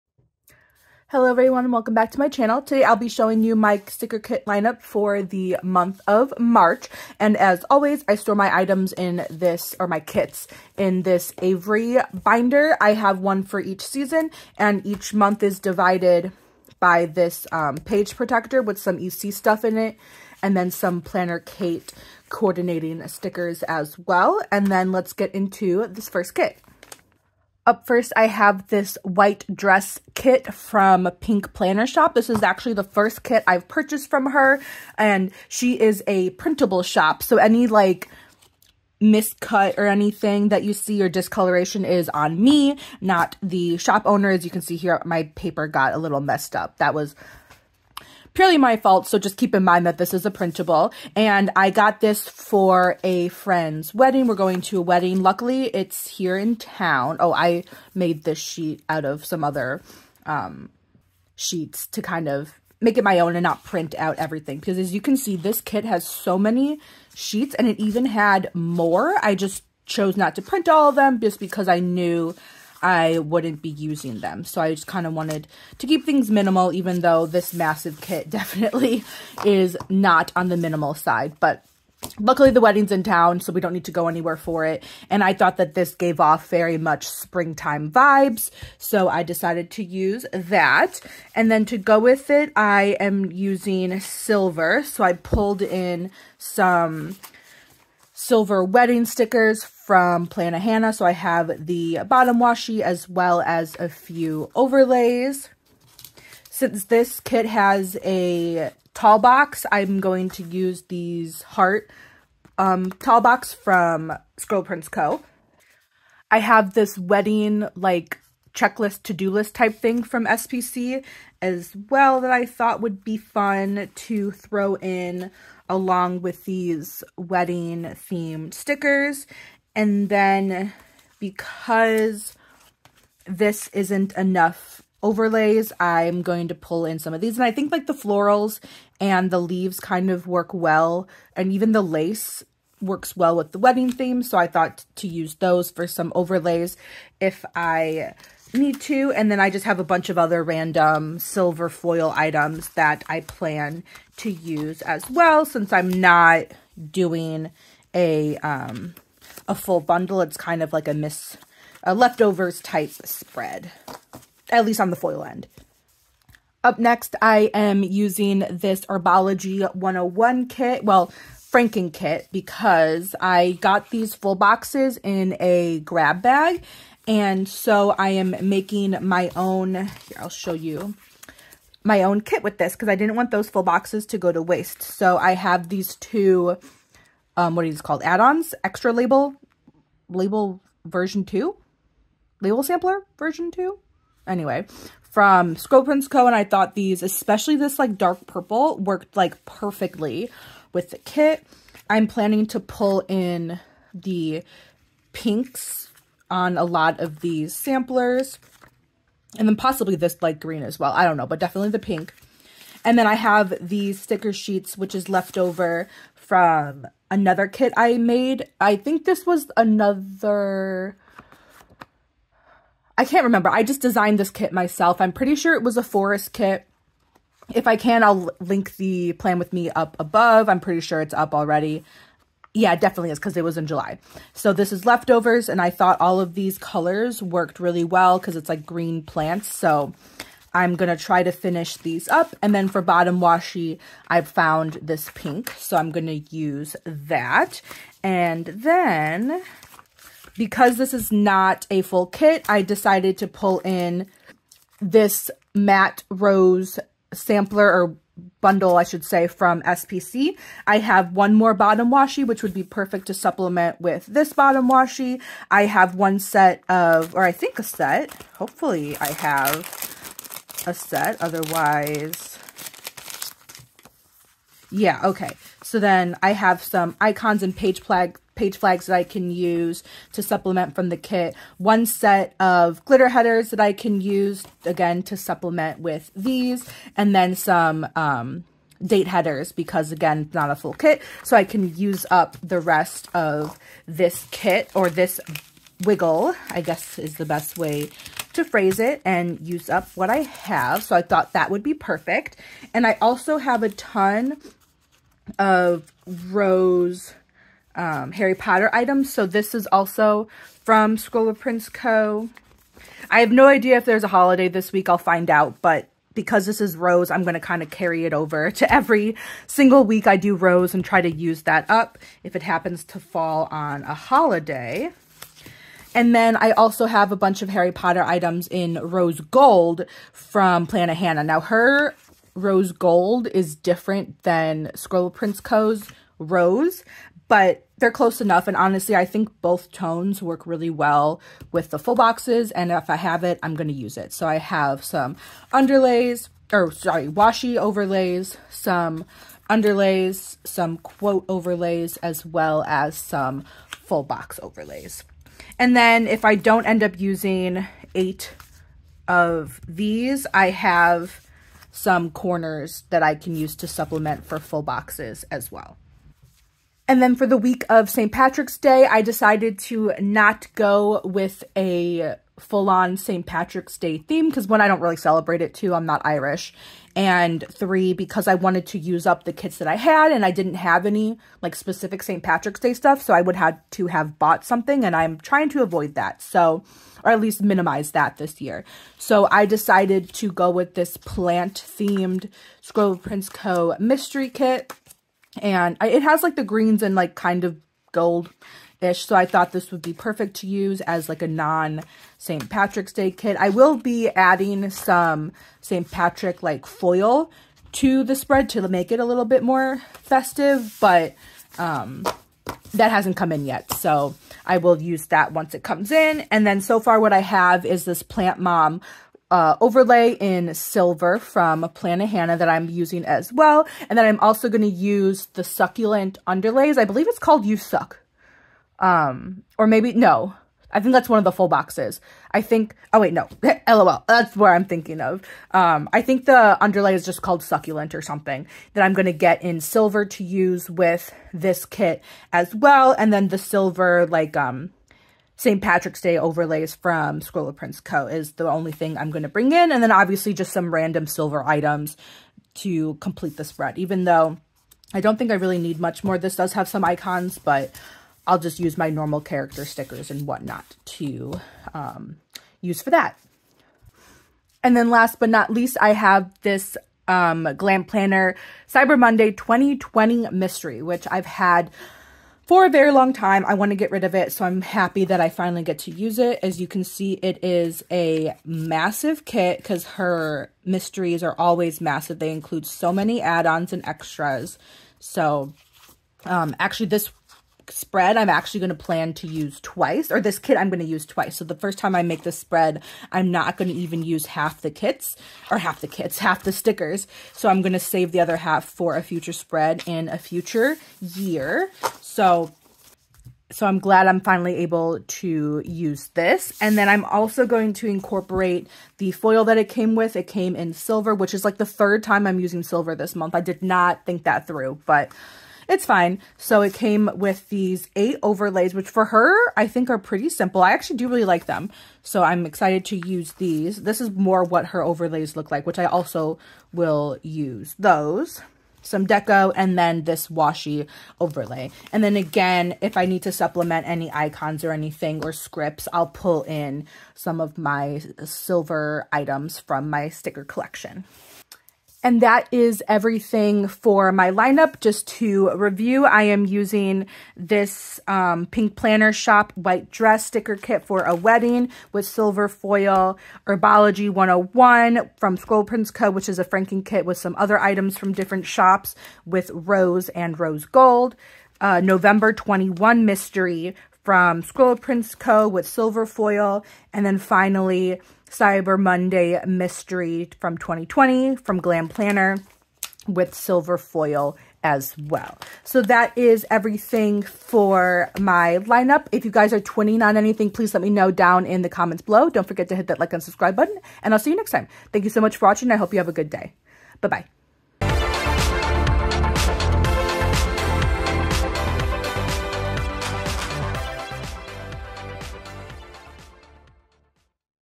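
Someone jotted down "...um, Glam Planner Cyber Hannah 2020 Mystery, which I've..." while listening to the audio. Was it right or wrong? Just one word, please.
wrong.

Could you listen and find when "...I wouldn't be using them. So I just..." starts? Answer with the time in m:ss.
1:12.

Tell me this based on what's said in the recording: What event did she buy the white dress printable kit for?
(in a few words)
A friend's wedding.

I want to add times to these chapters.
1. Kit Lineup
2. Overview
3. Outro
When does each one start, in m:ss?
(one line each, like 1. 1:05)
1. 0:27
2. 9:01
3. 9:35.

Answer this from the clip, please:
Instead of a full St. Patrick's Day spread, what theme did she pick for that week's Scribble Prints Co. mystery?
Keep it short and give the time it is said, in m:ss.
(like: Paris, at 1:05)
Plant themed, at 6:30.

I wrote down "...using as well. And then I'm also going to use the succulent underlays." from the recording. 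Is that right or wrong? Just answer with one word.
right.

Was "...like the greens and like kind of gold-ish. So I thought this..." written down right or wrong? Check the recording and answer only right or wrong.
right.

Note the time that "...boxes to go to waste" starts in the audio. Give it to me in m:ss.
3:03.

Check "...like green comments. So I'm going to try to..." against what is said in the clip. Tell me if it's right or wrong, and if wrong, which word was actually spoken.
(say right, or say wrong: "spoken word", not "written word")
wrong: "plants", not "comments".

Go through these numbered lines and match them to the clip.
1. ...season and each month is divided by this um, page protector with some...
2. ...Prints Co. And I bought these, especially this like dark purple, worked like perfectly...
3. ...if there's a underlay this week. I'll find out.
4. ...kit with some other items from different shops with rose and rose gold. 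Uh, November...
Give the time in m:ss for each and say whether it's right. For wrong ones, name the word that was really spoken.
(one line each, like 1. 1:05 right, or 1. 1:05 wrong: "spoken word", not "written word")
1. 0:13 right
2. 3:15 wrong: "thought", not "bought"
3. 5:13 wrong: "holiday", not "underlay"
4. 9:16 right.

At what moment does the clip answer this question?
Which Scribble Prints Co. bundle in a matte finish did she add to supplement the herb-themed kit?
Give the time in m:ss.
4:15.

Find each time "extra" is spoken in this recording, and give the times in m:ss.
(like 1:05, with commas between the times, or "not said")
3:08, 8:03.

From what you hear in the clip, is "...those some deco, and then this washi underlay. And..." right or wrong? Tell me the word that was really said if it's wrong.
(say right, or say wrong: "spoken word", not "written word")
wrong: "overlay", not "underlay".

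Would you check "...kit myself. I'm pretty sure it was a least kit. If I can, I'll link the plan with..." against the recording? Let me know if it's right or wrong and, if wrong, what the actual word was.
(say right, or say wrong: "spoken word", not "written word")
wrong: "forest", not "least".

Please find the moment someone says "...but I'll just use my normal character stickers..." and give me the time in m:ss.
7:37.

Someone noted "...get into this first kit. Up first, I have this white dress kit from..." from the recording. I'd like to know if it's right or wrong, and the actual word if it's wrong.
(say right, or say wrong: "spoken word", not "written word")
right.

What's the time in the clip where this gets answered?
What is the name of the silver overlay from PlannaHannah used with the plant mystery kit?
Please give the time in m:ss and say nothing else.
6:58.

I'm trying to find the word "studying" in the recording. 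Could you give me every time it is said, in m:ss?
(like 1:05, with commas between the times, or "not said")
not said.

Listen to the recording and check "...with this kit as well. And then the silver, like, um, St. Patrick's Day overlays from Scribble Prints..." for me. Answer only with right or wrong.
right.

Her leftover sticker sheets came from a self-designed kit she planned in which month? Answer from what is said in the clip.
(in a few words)
July.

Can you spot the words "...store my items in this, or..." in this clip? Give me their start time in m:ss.
0:08.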